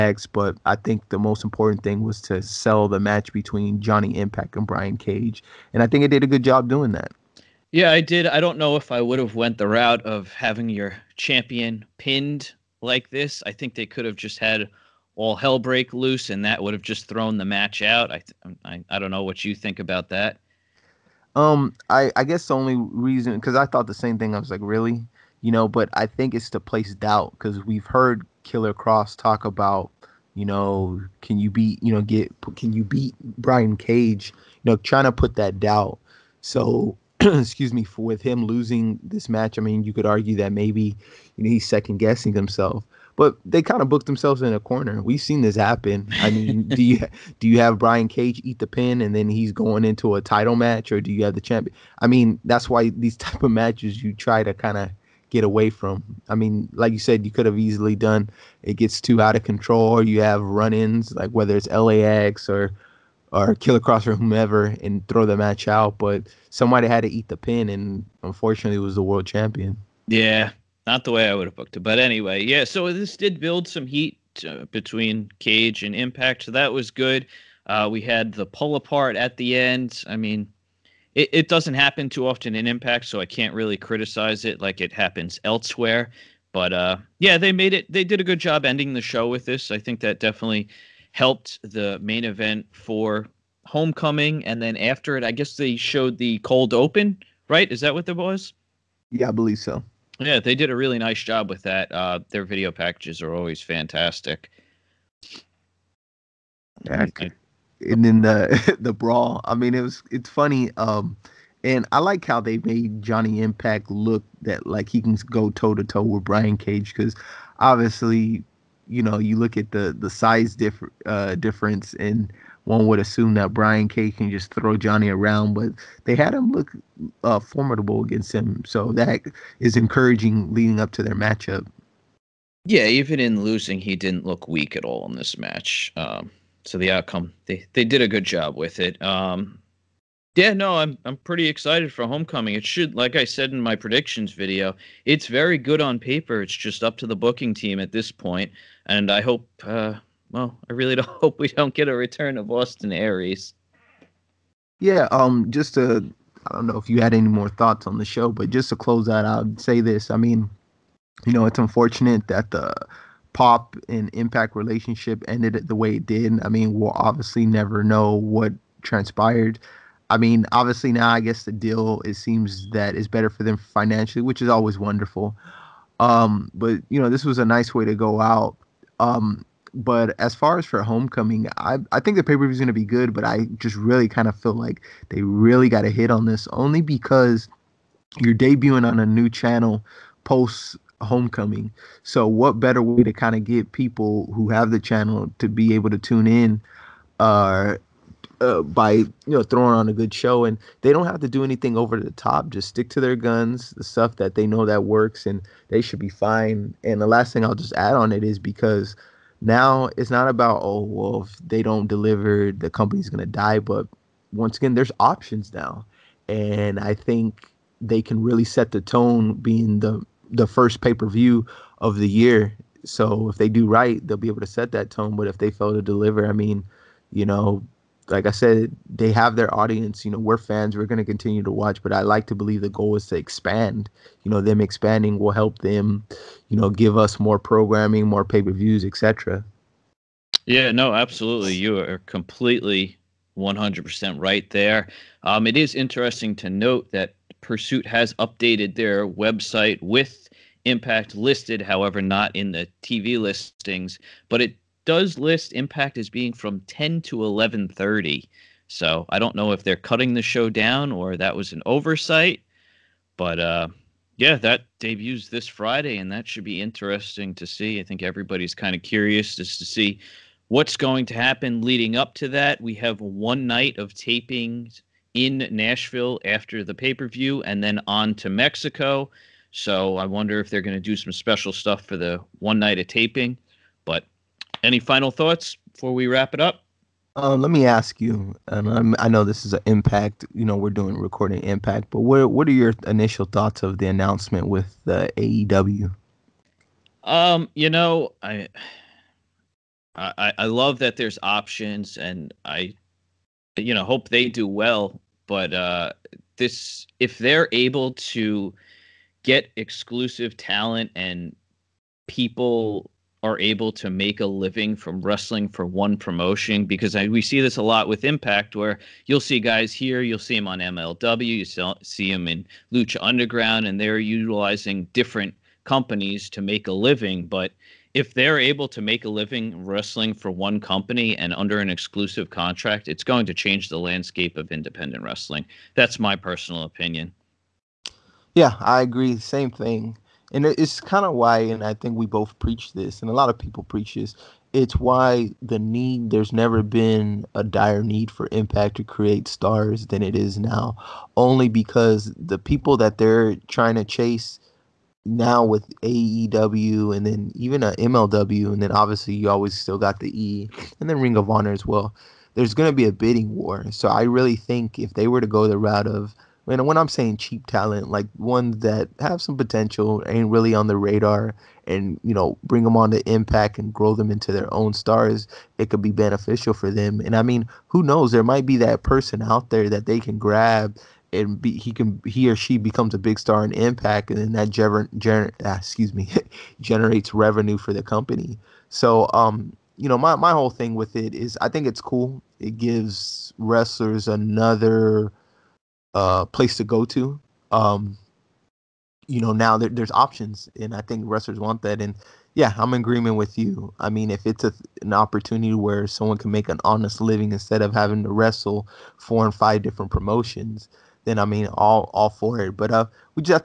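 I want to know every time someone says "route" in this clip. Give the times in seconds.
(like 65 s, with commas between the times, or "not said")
9 s, 365 s.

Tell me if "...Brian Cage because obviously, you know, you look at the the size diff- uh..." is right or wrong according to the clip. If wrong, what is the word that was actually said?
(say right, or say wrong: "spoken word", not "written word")
right.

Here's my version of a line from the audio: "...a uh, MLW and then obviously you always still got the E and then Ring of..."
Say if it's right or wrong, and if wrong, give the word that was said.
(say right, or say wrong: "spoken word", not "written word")
right.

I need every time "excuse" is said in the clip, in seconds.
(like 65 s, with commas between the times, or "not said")
37 s, 385 s.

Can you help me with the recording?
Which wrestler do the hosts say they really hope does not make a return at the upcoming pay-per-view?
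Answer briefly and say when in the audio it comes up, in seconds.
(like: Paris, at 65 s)
Austin Aries, at 152 s.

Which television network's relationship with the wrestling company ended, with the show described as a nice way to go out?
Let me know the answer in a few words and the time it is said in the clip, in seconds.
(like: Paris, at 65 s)
Pop, at 163 s.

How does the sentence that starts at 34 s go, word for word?
You know, trying to put that doubt.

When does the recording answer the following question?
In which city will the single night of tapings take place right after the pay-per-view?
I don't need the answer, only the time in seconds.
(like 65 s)
275 s.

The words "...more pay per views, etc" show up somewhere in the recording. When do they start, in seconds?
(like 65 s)
238 s.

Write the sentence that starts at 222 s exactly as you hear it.
So if they do right, they'll be able to set that tone.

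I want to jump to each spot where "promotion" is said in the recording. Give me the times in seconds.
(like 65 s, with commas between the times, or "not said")
315 s, 409 s.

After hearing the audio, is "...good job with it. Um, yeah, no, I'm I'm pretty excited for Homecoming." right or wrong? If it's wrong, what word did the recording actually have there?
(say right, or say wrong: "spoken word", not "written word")
right.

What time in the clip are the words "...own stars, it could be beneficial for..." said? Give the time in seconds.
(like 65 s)
374 s.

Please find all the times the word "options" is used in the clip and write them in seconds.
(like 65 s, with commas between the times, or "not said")
214 s, 301 s, 399 s.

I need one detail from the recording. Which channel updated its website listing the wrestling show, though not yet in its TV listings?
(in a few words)
Pursuit.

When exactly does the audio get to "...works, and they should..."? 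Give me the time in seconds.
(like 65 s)
204 s.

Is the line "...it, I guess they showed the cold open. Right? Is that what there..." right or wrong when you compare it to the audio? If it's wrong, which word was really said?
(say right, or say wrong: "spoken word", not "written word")
right.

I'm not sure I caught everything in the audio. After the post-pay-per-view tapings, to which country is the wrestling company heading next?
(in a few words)
Mexico.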